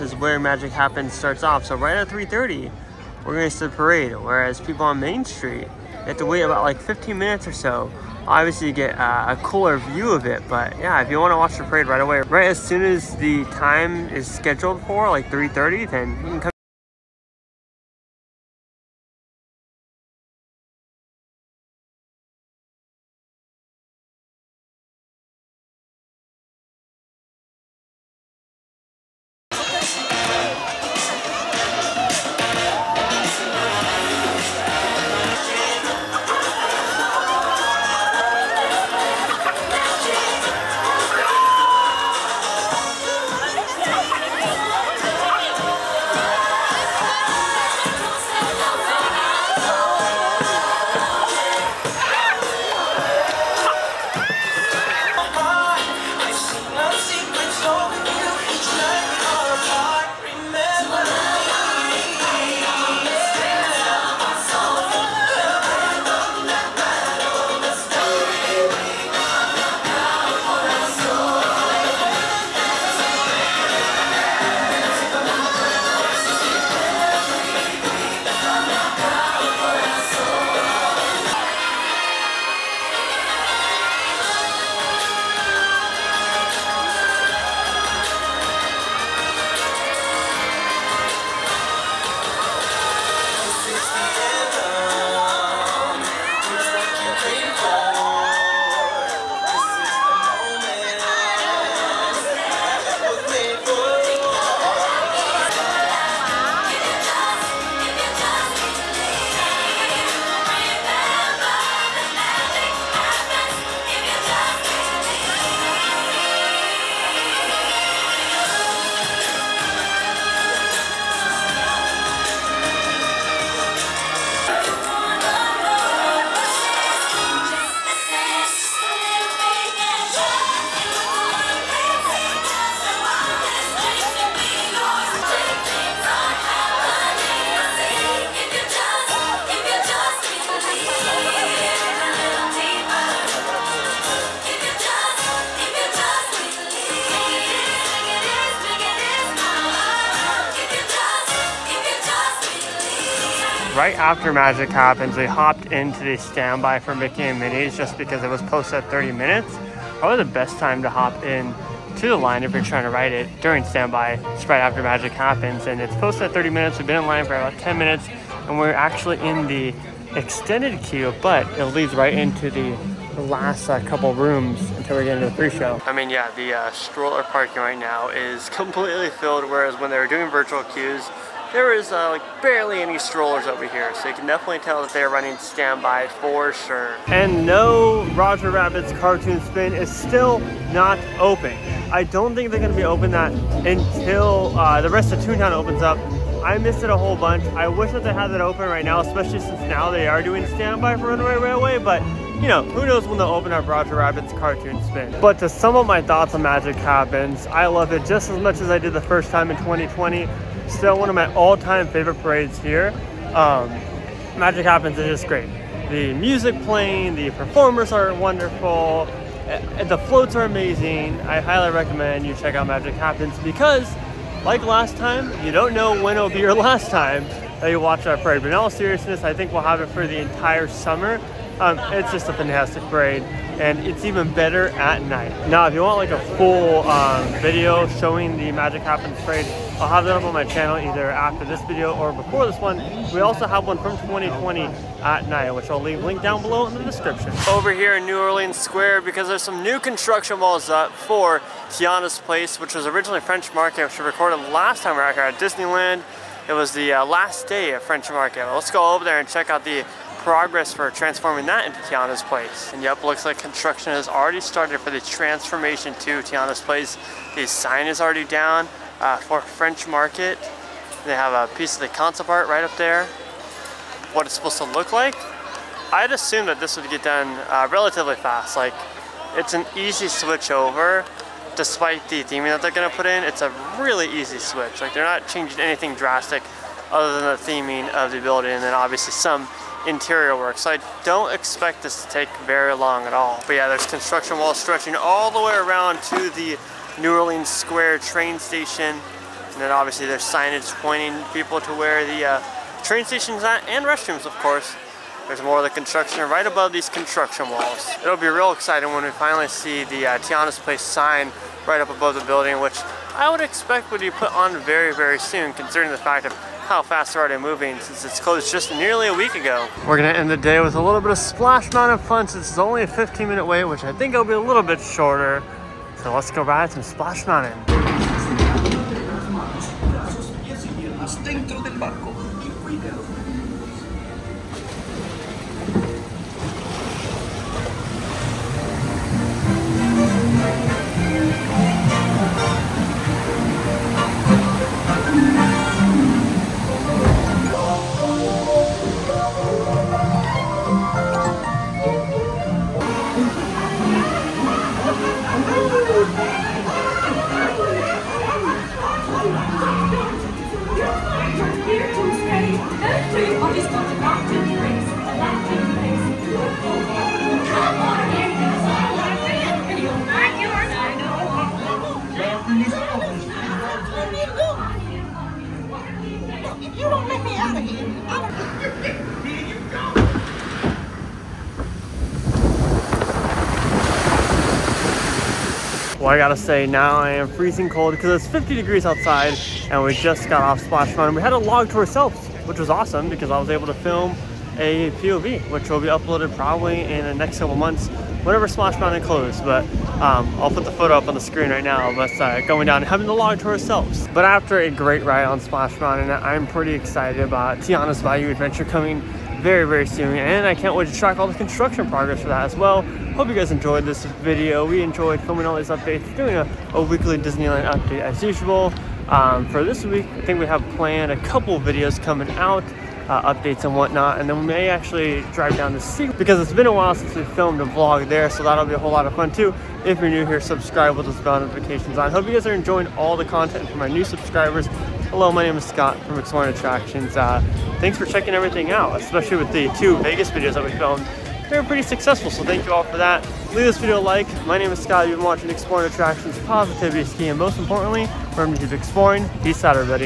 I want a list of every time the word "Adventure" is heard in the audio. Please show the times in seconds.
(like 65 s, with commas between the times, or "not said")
408 s.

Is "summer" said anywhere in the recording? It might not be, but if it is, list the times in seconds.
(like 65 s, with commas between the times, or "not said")
230 s.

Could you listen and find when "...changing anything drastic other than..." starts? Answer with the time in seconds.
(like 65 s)
285 s.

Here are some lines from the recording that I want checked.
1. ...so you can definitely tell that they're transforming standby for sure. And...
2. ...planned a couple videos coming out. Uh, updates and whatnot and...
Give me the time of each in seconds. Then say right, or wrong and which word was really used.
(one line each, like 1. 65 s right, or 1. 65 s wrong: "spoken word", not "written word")
1. 183 s wrong: "running", not "transforming"
2. 420 s right.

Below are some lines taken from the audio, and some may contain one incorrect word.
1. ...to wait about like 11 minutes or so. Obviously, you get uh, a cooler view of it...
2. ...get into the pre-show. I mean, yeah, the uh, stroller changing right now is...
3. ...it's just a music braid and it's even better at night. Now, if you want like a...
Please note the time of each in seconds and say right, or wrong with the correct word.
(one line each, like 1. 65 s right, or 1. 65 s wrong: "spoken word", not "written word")
1. 6 s wrong: "15", not "11"
2. 175 s wrong: "parking", not "changing"
3. 231 s wrong: "fantastic", not "music".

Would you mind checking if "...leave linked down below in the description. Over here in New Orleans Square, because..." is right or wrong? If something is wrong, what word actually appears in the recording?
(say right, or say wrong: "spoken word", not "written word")
right.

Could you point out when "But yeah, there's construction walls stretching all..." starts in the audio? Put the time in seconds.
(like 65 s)
293 s.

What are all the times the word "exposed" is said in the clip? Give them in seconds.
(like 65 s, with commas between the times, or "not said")
not said.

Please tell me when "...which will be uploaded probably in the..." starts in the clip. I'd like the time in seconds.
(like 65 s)
395 s.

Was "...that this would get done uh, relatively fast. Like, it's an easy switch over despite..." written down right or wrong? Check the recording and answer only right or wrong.
right.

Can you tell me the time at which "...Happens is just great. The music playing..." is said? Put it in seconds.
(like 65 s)
214 s.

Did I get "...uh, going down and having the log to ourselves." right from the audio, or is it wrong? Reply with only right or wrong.
right.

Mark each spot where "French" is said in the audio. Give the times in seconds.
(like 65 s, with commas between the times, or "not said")
253 s, 257 s, 269 s.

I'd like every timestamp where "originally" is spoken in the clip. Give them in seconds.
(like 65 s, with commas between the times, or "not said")
252 s.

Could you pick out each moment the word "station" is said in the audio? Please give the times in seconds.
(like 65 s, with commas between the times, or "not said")
298 s, 303 s.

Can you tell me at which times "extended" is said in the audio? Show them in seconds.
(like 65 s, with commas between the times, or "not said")
170 s.